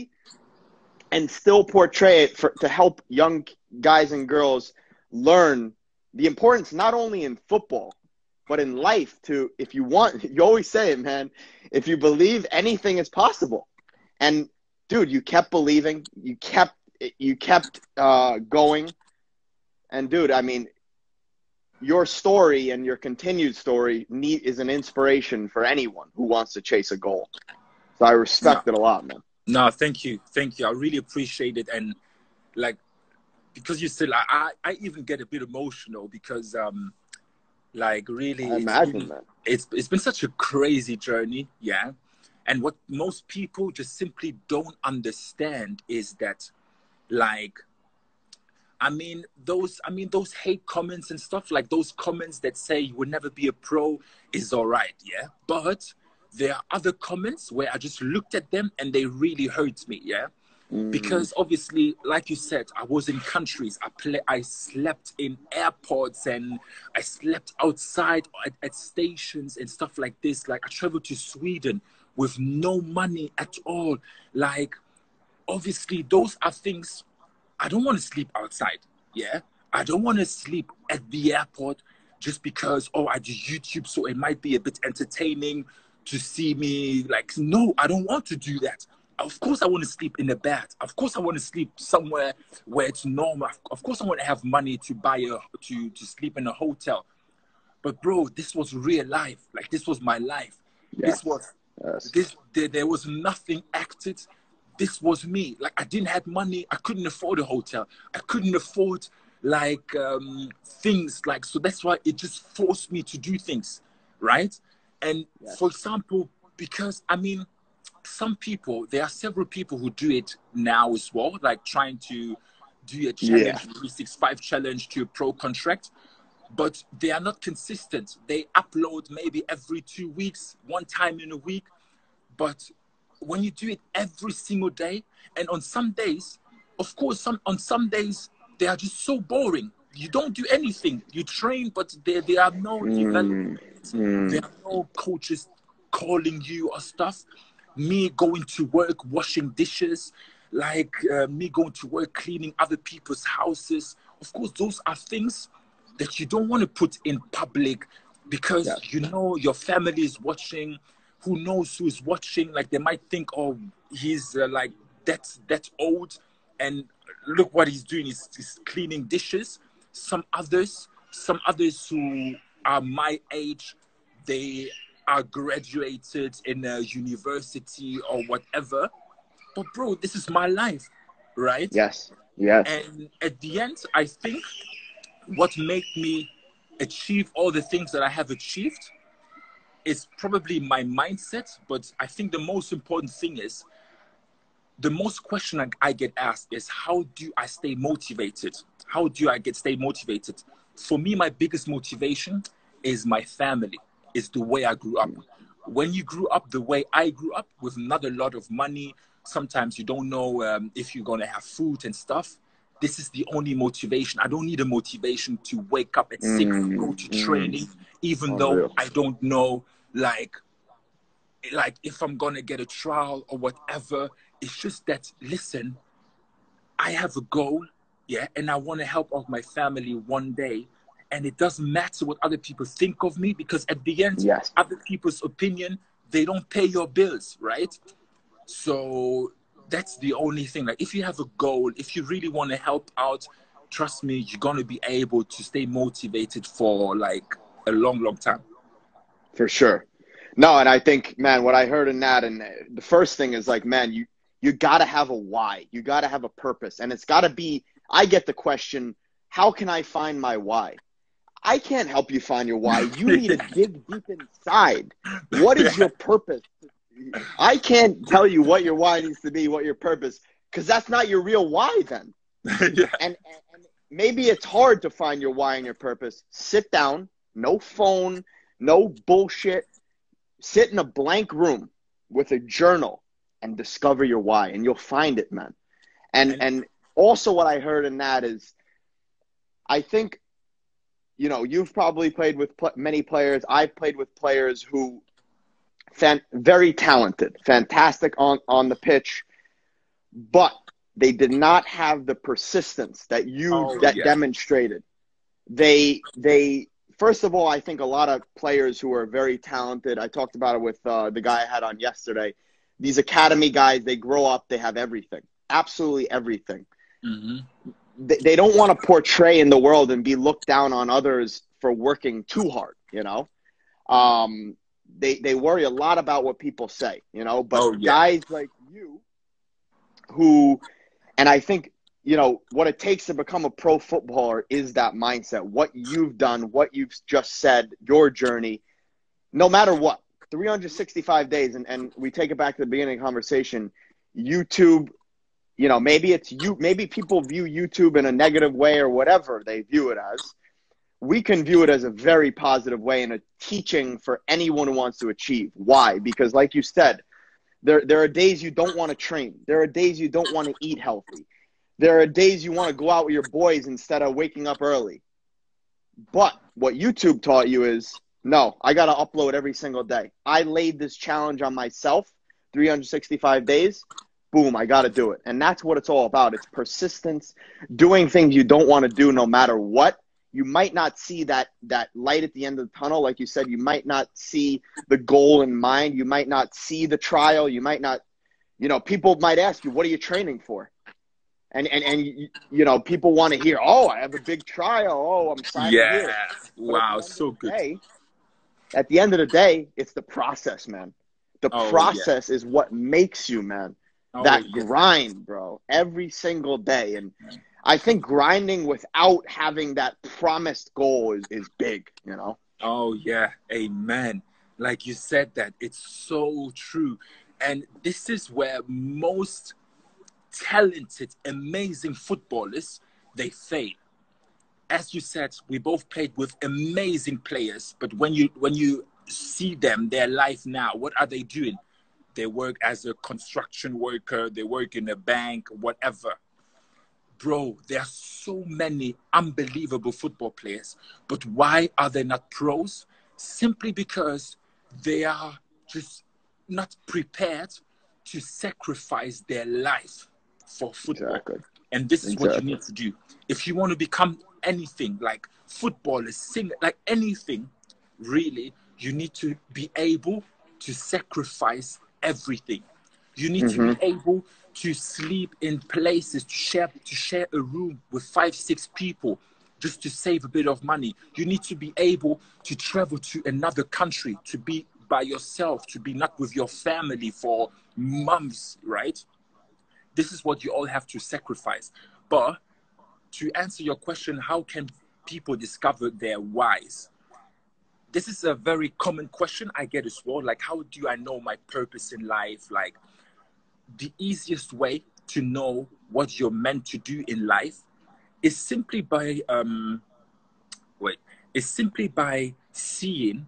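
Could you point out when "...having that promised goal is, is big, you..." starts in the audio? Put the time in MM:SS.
06:49.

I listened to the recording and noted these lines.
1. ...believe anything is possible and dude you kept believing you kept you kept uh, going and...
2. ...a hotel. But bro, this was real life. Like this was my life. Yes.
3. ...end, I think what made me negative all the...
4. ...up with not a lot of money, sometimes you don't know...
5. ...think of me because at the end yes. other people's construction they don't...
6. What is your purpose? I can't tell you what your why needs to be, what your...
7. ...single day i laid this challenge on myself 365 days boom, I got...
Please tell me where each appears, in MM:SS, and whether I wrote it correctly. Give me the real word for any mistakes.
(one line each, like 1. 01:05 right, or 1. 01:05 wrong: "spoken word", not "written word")
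1. 00:11 right
2. 01:36 right
3. 03:03 wrong: "achieve", not "negative"
4. 03:27 right
5. 03:52 wrong: "opinion", not "construction"
6. 04:25 right
7. 06:09 right.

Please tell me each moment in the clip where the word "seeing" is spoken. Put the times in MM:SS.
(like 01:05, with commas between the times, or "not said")
08:22.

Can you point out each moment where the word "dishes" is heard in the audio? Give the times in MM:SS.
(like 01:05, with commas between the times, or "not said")
02:29, 02:49.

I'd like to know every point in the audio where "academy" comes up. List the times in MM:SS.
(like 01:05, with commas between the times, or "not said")
05:12.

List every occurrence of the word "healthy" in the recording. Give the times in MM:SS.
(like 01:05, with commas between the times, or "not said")
06:00.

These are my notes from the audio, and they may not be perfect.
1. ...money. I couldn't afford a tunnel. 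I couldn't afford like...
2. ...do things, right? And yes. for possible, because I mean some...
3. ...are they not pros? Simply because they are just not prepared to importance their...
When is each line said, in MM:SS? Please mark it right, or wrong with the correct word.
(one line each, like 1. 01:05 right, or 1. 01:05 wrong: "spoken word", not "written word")
1. 01:46 wrong: "hotel", not "tunnel"
2. 01:53 wrong: "example", not "possible"
3. 07:21 wrong: "sacrifice", not "importance".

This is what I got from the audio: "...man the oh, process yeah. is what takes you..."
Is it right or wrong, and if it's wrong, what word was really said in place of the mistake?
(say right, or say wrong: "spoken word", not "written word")
wrong: "makes", not "takes".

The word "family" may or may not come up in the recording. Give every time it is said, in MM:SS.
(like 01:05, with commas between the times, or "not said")
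02:39, 03:23, 03:49, 07:56.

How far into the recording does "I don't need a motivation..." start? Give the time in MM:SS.
03:34.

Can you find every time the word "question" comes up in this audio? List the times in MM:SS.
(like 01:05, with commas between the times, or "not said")
03:15, 04:18, 08:03, 08:09.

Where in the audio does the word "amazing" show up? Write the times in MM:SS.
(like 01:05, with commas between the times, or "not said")
07:01, 07:06.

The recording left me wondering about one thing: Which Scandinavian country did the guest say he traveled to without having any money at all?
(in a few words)
Sweden.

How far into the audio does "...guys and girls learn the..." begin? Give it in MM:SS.
00:03.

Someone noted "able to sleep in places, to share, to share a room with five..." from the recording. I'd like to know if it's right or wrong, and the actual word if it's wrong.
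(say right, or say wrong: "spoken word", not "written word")
right.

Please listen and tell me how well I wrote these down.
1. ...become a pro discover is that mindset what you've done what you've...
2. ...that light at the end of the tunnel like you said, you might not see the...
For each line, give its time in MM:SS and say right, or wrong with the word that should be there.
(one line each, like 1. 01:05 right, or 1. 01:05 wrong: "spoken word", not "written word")
1. 05:33 wrong: "footballer", not "discover"
2. 06:21 right.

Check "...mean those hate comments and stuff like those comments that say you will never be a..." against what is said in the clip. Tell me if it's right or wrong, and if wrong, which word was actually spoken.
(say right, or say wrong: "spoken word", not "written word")
right.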